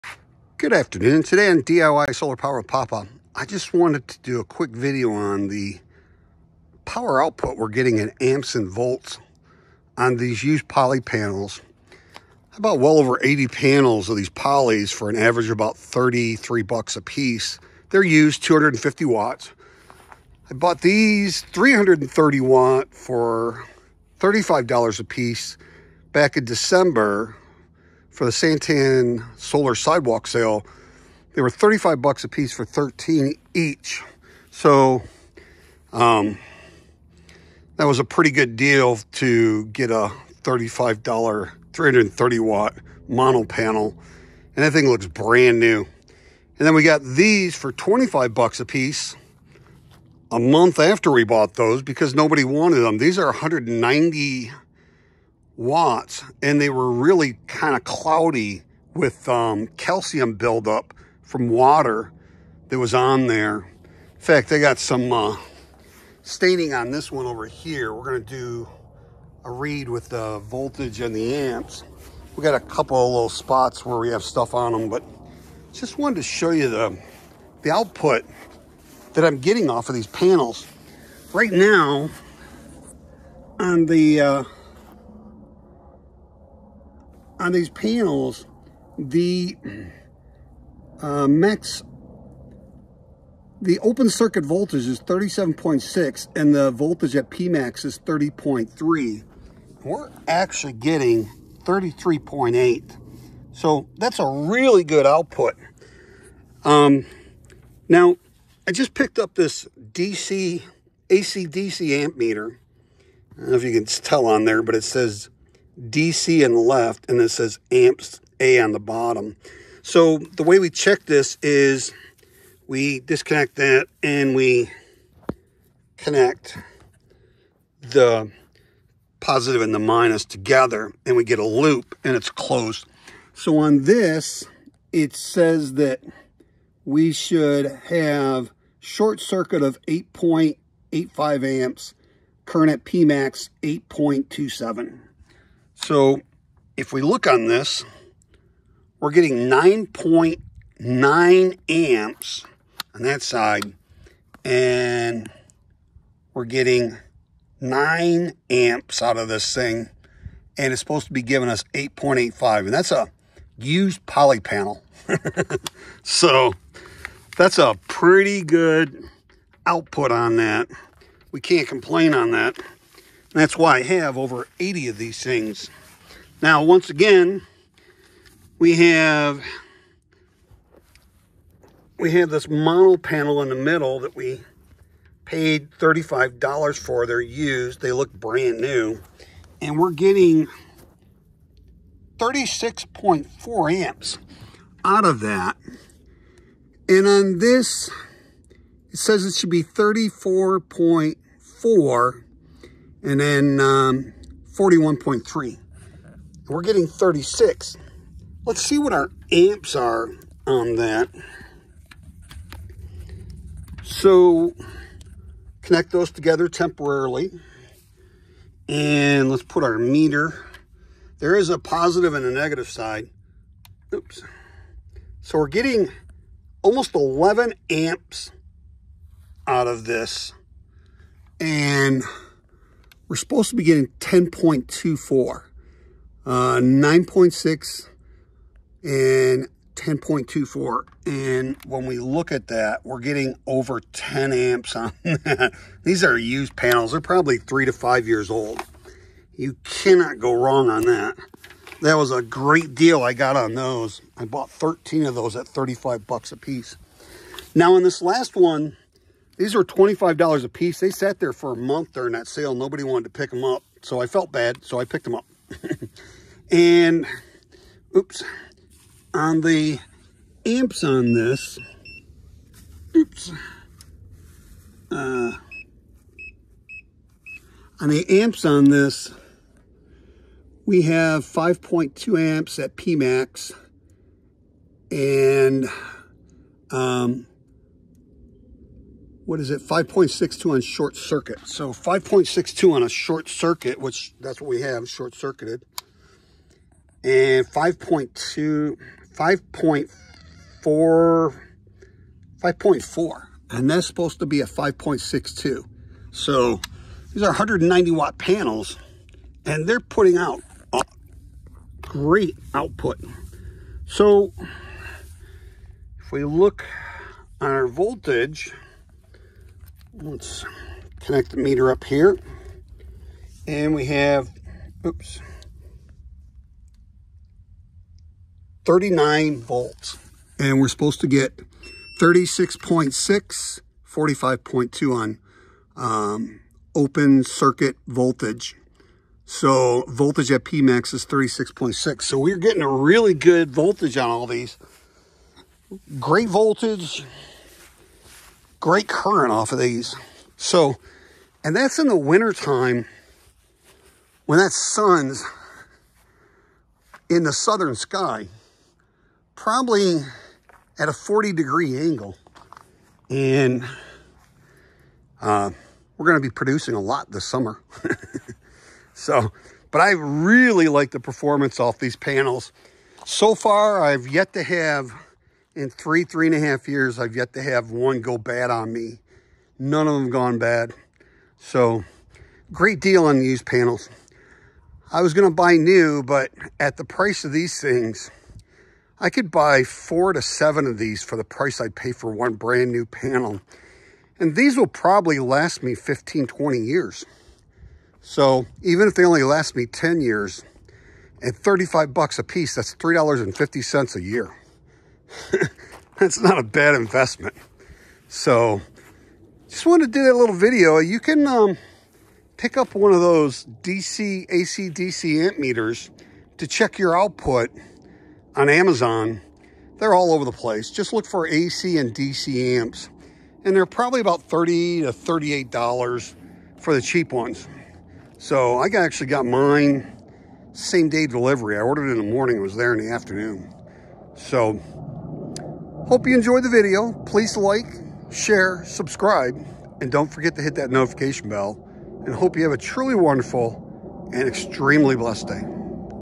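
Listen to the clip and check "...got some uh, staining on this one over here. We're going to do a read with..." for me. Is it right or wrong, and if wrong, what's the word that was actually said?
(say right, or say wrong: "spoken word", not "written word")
right.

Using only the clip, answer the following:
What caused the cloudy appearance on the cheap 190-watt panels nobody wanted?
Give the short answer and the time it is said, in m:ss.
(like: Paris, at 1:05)
Calcium buildup, at 0:59.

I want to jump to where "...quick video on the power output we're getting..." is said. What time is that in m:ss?
0:04.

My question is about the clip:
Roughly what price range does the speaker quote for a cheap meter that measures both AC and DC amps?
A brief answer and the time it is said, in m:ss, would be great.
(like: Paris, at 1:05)
$30 to $38, at 7:04.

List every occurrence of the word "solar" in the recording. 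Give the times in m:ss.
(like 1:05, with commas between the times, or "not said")
0:02, 0:29.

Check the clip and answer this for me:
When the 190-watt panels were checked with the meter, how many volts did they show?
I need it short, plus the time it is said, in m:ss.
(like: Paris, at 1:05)
39 volts, at 5:28.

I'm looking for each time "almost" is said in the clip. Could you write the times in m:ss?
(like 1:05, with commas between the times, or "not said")
3:46.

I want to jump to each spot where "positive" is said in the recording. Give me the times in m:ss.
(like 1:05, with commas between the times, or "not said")
2:09, 3:41.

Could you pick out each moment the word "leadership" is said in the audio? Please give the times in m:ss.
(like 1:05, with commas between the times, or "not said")
not said.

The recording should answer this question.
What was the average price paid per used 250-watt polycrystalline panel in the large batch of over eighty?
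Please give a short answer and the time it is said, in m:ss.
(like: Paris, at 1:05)
$33, at 0:15.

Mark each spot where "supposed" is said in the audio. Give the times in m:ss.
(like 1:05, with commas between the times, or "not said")
2:40, 3:53, 5:03, 5:30.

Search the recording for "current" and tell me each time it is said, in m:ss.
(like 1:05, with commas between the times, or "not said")
2:22, 5:48.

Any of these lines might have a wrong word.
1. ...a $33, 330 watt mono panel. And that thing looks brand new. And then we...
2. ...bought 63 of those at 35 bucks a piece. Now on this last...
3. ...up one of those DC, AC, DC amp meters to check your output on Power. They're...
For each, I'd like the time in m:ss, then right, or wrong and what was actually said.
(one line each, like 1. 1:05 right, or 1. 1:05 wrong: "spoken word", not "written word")
1. 0:39 wrong: "35", not "33"
2. 4:14 wrong: "13", not "63"
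3. 6:52 wrong: "Amazon", not "Power".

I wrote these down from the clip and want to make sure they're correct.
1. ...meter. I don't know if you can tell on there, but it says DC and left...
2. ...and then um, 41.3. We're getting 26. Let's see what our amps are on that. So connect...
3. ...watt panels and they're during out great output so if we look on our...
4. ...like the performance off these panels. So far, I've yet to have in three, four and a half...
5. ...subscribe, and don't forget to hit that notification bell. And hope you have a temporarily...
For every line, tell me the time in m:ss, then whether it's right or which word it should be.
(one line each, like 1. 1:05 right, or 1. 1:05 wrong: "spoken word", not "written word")
1. 1:52 right
2. 3:23 wrong: "36", not "26"
3. 5:07 wrong: "putting", not "during"
4. 6:10 wrong: "three", not "four"
5. 7:18 wrong: "truly", not "temporarily".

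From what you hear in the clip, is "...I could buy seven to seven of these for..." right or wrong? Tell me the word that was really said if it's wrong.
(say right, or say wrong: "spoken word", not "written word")
wrong: "four", not "seven".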